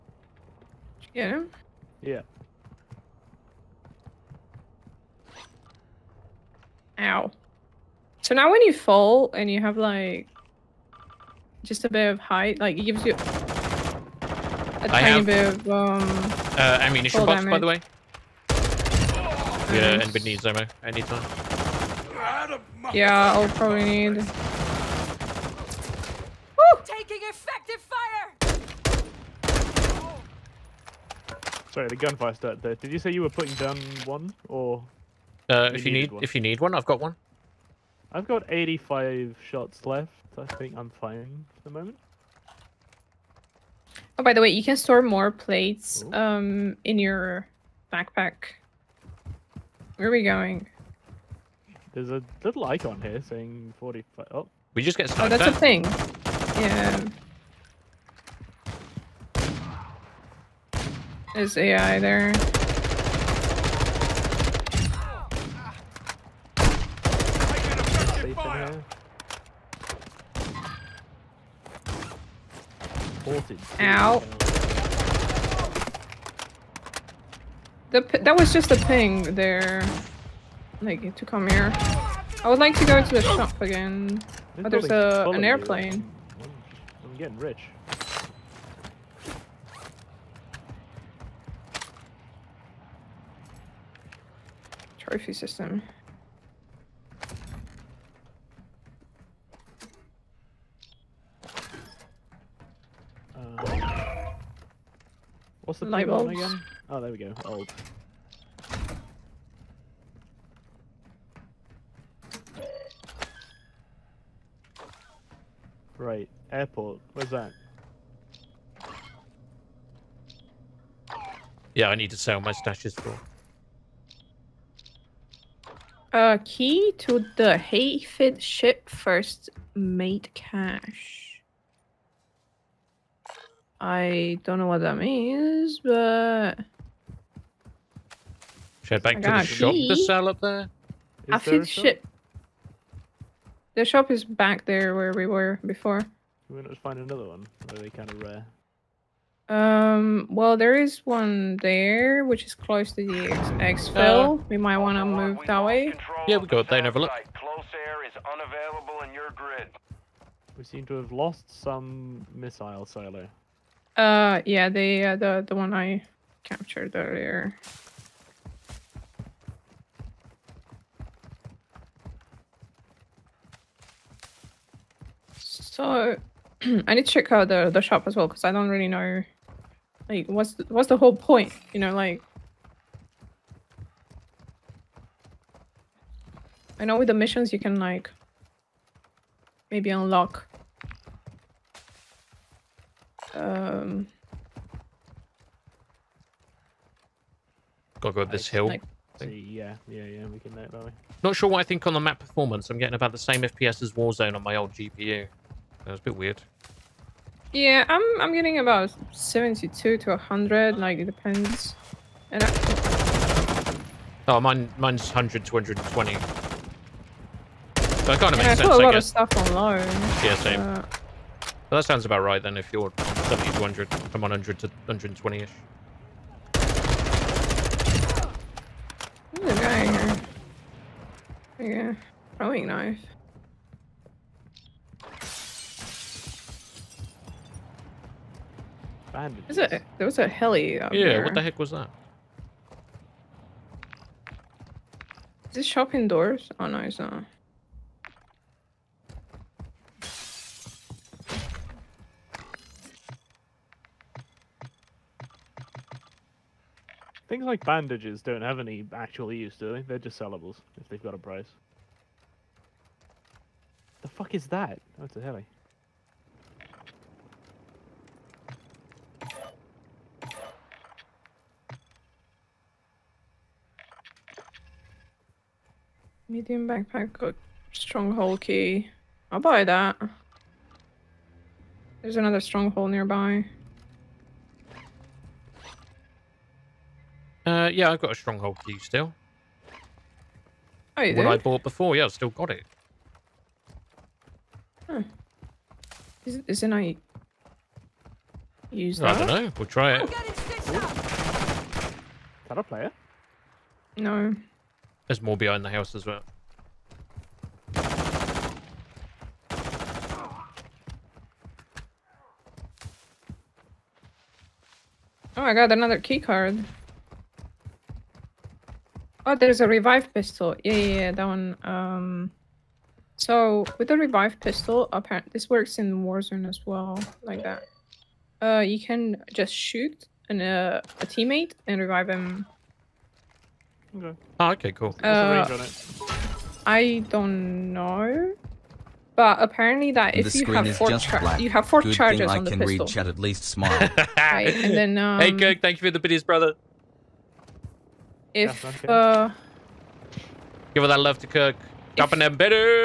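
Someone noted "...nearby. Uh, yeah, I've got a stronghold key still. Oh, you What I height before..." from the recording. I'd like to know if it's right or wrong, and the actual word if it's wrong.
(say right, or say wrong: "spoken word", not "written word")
wrong: "bought", not "height".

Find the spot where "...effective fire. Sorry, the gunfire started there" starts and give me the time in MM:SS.
00:27.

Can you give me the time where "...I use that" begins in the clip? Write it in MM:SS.
04:56.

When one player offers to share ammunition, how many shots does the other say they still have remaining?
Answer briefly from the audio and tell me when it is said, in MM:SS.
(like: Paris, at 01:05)
85, at 00:38.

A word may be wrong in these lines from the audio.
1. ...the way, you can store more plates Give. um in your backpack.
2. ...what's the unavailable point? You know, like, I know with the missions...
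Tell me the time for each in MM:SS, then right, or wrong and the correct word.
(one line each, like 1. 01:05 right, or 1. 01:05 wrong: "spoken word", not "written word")
1. 00:44 wrong: "Ooh", not "Give"
2. 03:00 wrong: "whole", not "unavailable".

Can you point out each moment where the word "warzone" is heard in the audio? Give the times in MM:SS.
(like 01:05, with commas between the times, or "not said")
03:23, 05:26.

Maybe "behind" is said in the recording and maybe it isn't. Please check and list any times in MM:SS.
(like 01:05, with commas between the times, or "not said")
05:05.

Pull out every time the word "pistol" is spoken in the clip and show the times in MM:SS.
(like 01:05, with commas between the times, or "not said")
05:20, 05:24, 05:42.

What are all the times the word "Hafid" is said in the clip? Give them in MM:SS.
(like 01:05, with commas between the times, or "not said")
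02:07.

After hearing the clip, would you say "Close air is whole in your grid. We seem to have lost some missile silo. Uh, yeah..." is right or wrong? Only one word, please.
wrong.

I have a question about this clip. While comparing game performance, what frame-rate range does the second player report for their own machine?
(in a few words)
100 to 120.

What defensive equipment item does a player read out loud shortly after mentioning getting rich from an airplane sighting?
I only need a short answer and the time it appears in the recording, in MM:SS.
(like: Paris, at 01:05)
Trophy system, at 01:34.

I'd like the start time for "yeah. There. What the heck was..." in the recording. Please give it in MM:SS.
04:00.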